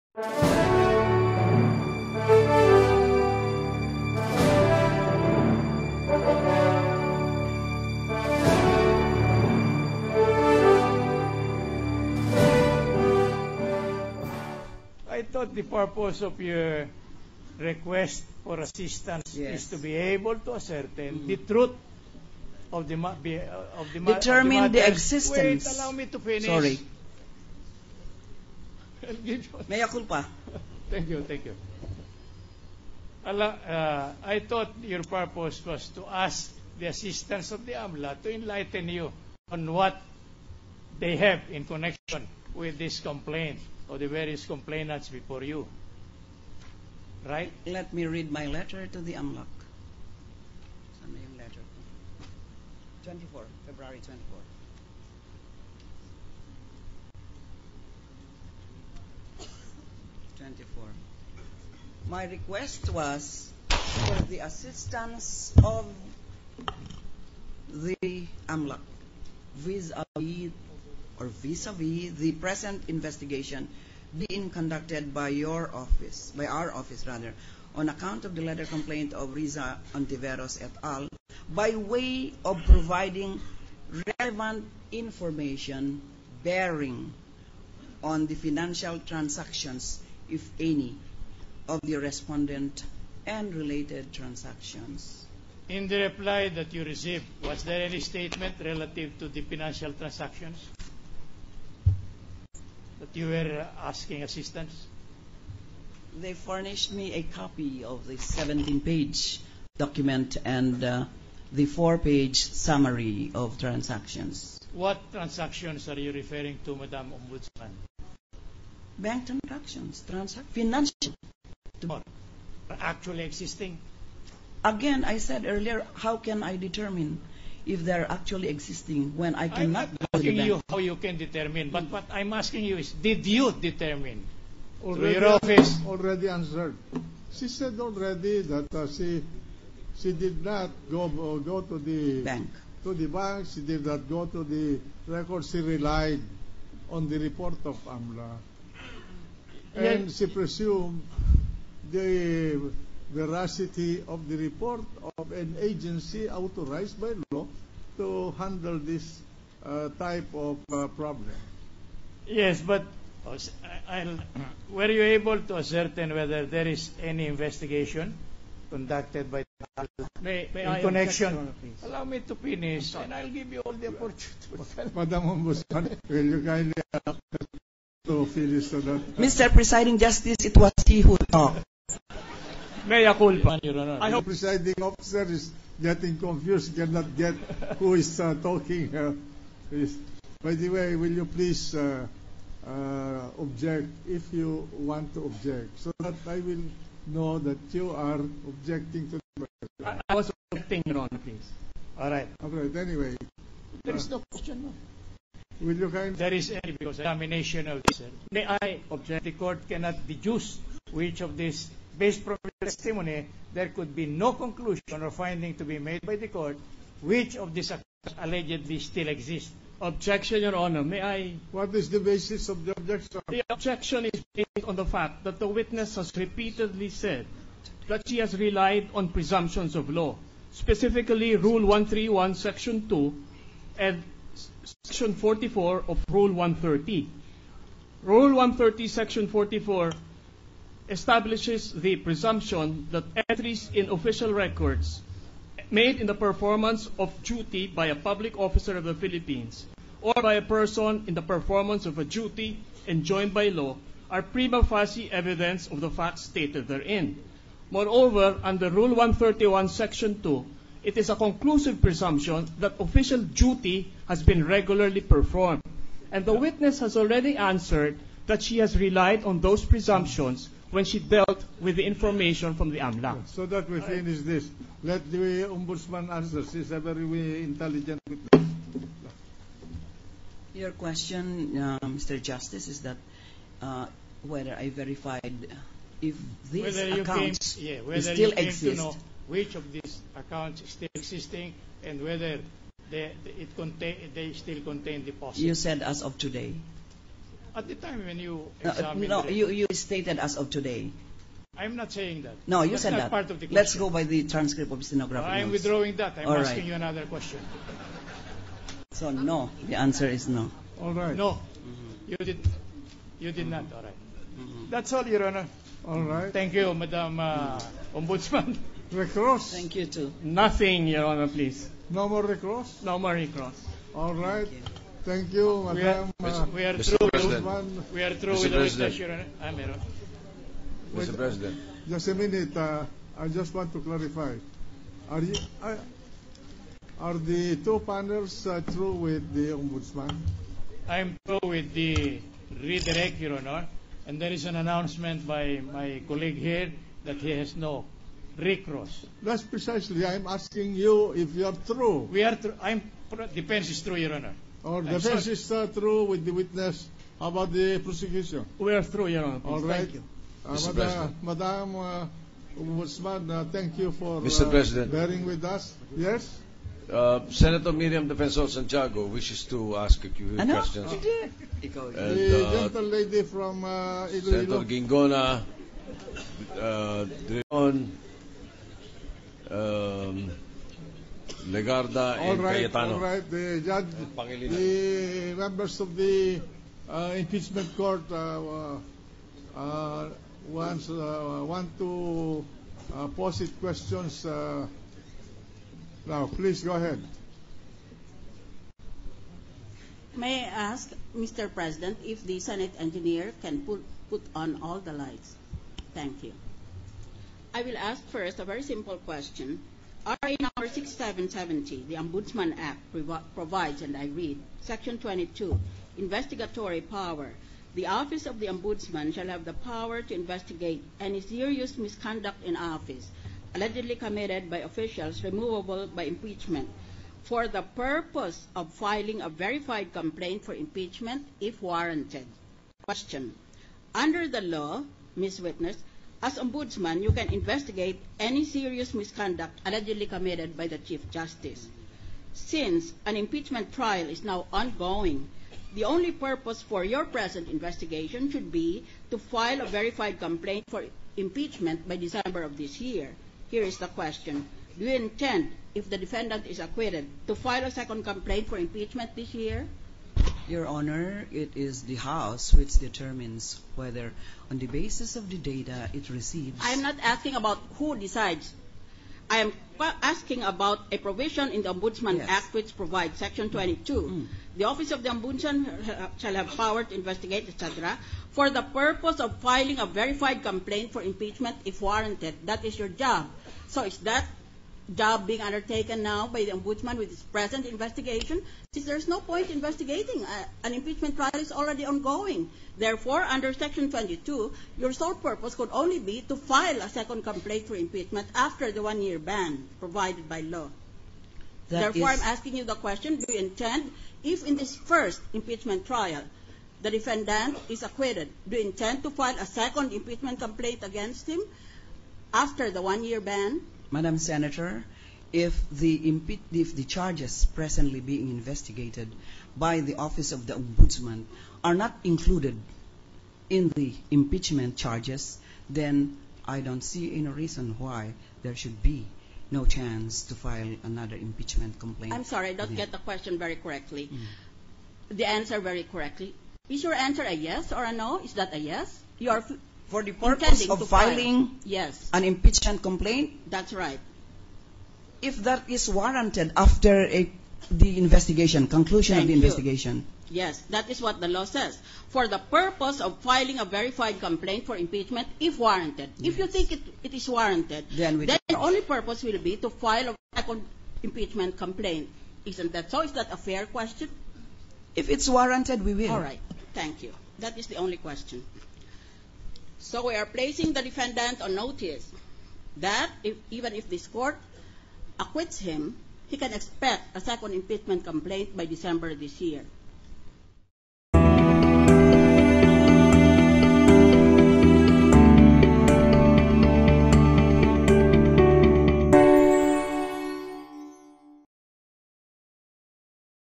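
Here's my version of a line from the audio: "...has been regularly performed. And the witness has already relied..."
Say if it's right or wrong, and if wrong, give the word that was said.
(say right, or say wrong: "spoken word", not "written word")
wrong: "answered", not "relied".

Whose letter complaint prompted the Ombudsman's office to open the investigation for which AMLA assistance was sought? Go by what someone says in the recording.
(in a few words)
Risa Hontiveros.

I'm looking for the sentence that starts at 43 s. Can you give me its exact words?
or the various complainants before you.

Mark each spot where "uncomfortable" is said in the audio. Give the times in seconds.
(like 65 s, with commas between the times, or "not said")
not said.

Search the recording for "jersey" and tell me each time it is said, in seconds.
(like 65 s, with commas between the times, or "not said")
not said.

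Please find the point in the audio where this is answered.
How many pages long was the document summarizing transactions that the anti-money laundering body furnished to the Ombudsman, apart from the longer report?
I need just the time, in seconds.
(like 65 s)
111 s.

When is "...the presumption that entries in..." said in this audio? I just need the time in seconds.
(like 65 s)
241 s.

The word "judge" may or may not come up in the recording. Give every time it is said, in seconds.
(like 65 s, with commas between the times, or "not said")
383 s.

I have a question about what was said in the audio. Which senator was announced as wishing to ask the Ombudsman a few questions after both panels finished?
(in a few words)
Miriam Defensor Santiago.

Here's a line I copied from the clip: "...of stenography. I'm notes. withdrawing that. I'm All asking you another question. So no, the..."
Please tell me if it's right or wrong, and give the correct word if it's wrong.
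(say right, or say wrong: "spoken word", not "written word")
right.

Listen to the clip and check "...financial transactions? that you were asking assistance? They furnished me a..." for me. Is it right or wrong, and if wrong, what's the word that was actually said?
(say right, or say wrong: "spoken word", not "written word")
right.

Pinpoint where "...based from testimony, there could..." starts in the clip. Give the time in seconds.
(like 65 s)
211 s.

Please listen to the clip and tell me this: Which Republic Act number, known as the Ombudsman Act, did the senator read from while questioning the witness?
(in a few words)
RA 6770.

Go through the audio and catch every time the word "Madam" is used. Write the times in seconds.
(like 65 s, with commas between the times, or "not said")
116 s, 174 s, 316 s, 325 s, 361 s, 513 s.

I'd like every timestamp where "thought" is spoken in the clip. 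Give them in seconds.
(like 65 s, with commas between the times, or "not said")
15 s, 34 s.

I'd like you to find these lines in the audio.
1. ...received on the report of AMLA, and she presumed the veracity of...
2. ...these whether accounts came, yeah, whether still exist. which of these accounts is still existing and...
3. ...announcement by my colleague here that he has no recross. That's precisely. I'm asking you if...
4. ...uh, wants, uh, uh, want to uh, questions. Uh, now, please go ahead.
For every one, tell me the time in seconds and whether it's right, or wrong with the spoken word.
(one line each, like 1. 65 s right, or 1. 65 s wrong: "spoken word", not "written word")
1. 145 s wrong: "relied", not "received"
2. 286 s right
3. 344 s right
4. 389 s right.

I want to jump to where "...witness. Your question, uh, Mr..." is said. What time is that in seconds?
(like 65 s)
278 s.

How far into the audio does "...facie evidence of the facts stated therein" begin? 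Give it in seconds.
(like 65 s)
254 s.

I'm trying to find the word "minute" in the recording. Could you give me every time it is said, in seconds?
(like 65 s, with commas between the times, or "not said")
332 s.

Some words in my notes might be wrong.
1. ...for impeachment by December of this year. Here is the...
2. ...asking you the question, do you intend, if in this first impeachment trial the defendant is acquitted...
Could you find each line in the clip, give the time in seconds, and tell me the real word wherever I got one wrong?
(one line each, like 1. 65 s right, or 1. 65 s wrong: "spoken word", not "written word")
1. 450 s right
2. 502 s right.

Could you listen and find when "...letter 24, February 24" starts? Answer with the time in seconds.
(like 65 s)
51 s.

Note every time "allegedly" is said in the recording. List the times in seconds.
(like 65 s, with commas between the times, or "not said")
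218 s, 423 s, 439 s.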